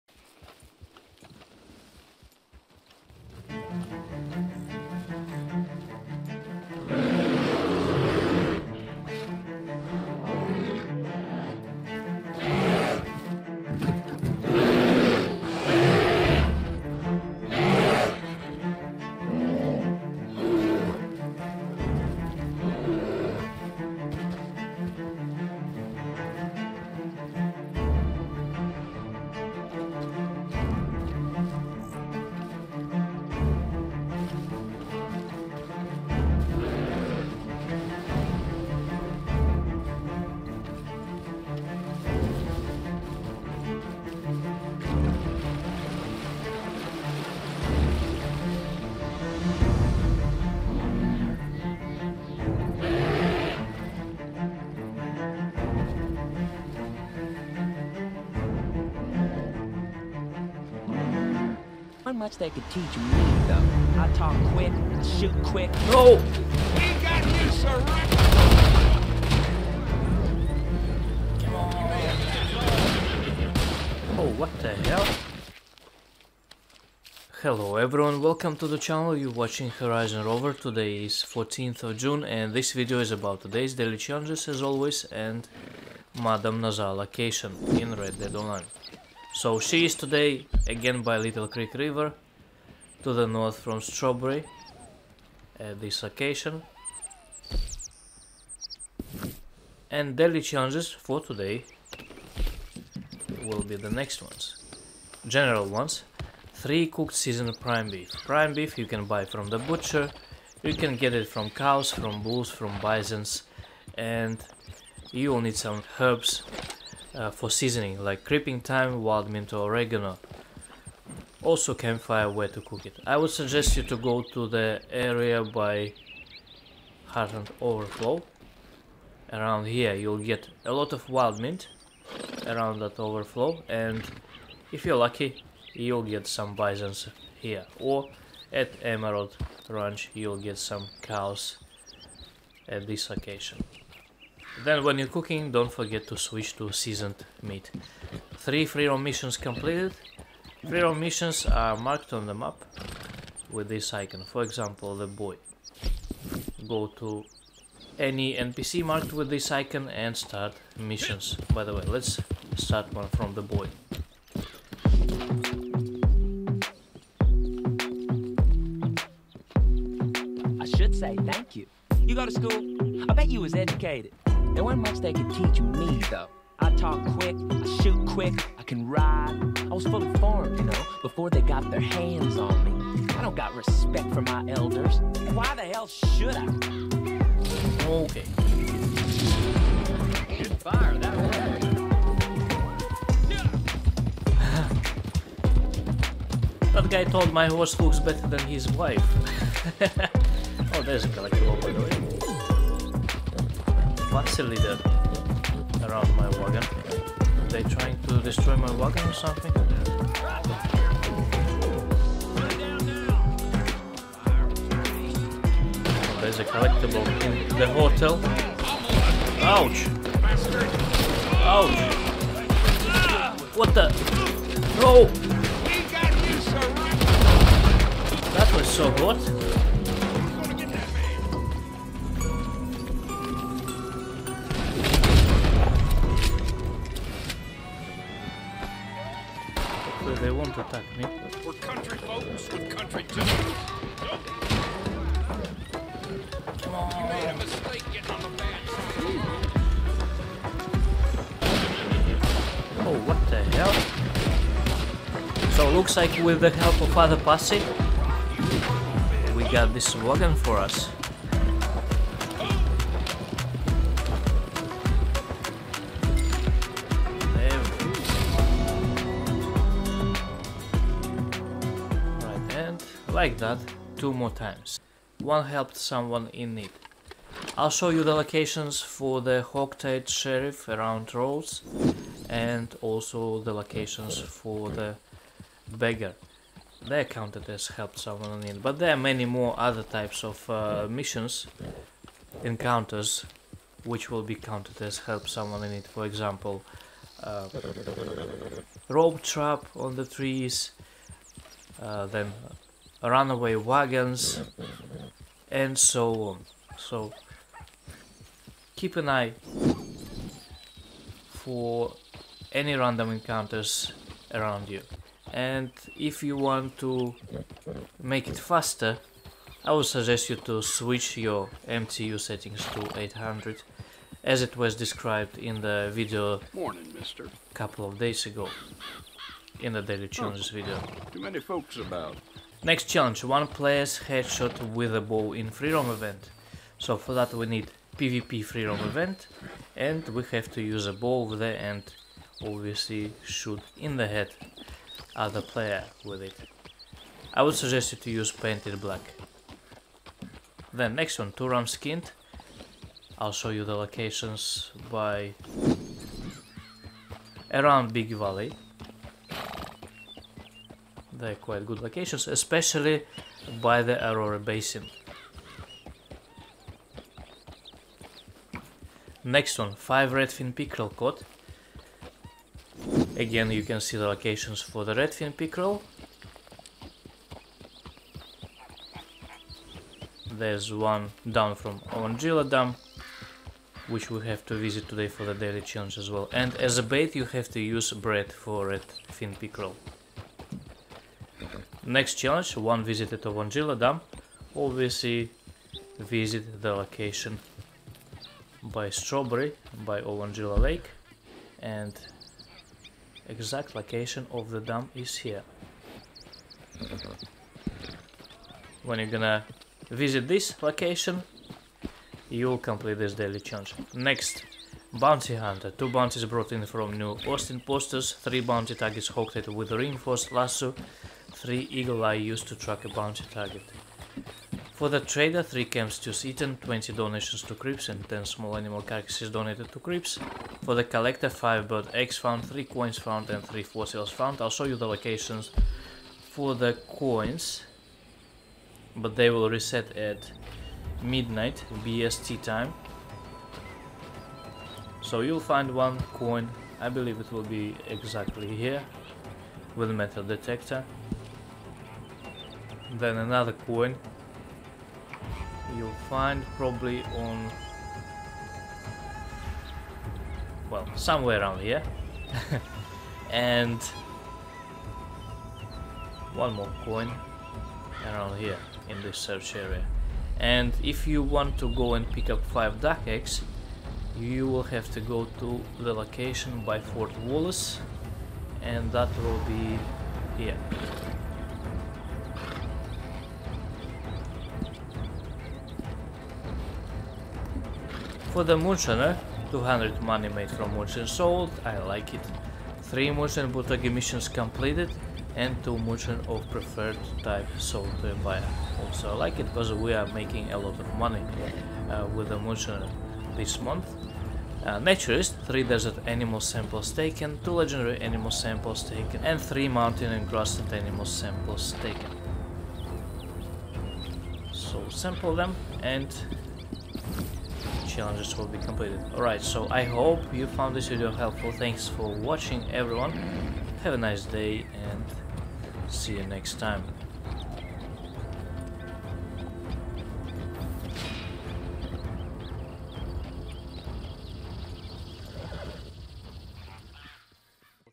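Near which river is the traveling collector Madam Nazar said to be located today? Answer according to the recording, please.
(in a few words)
Little Creek River.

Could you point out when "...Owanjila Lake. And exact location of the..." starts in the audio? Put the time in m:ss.
6:40.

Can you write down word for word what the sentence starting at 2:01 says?
Also campfire where to cook it.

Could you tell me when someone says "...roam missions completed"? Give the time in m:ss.
2:28.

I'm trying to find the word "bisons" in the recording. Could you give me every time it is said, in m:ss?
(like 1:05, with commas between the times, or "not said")
1:52, 2:16.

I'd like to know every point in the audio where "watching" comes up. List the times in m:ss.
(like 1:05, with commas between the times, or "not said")
1:19, 8:42.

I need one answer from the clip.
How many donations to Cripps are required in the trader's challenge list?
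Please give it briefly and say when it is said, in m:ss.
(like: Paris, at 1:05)
20, at 7:06.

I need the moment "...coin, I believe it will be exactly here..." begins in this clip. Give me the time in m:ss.
7:26.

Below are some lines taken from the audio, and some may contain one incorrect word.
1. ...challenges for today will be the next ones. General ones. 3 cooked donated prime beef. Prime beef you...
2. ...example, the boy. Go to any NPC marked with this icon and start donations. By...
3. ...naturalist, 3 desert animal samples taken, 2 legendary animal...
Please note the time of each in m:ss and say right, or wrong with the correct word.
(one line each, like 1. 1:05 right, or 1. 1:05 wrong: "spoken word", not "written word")
1. 1:40 wrong: "seasoned", not "donated"
2. 2:34 wrong: "missions", not "donations"
3. 8:24 right.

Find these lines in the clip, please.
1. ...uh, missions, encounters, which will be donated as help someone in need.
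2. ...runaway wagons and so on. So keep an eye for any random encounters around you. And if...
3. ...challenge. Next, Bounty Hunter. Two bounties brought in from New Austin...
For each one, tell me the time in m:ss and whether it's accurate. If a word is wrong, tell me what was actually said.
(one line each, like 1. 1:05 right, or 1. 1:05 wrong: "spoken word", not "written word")
1. 4:50 wrong: "counted", not "donated"
2. 5:03 right
3. 6:53 right.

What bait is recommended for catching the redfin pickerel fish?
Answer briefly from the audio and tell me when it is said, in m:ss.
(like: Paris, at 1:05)
bread, at 6:27.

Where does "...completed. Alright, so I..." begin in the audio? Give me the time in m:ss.
8:38.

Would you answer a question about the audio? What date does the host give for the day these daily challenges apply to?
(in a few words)
14th of June.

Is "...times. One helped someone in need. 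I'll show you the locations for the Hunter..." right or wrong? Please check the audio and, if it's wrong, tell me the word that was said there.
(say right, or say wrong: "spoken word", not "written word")
wrong: "Hogtied", not "Hunter".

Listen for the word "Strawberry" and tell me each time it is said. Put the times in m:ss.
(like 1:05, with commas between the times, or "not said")
1:33, 6:38.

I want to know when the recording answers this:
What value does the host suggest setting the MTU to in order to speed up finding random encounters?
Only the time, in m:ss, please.
5:22.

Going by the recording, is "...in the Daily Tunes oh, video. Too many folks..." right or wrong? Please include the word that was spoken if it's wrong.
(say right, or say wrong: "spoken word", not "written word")
right.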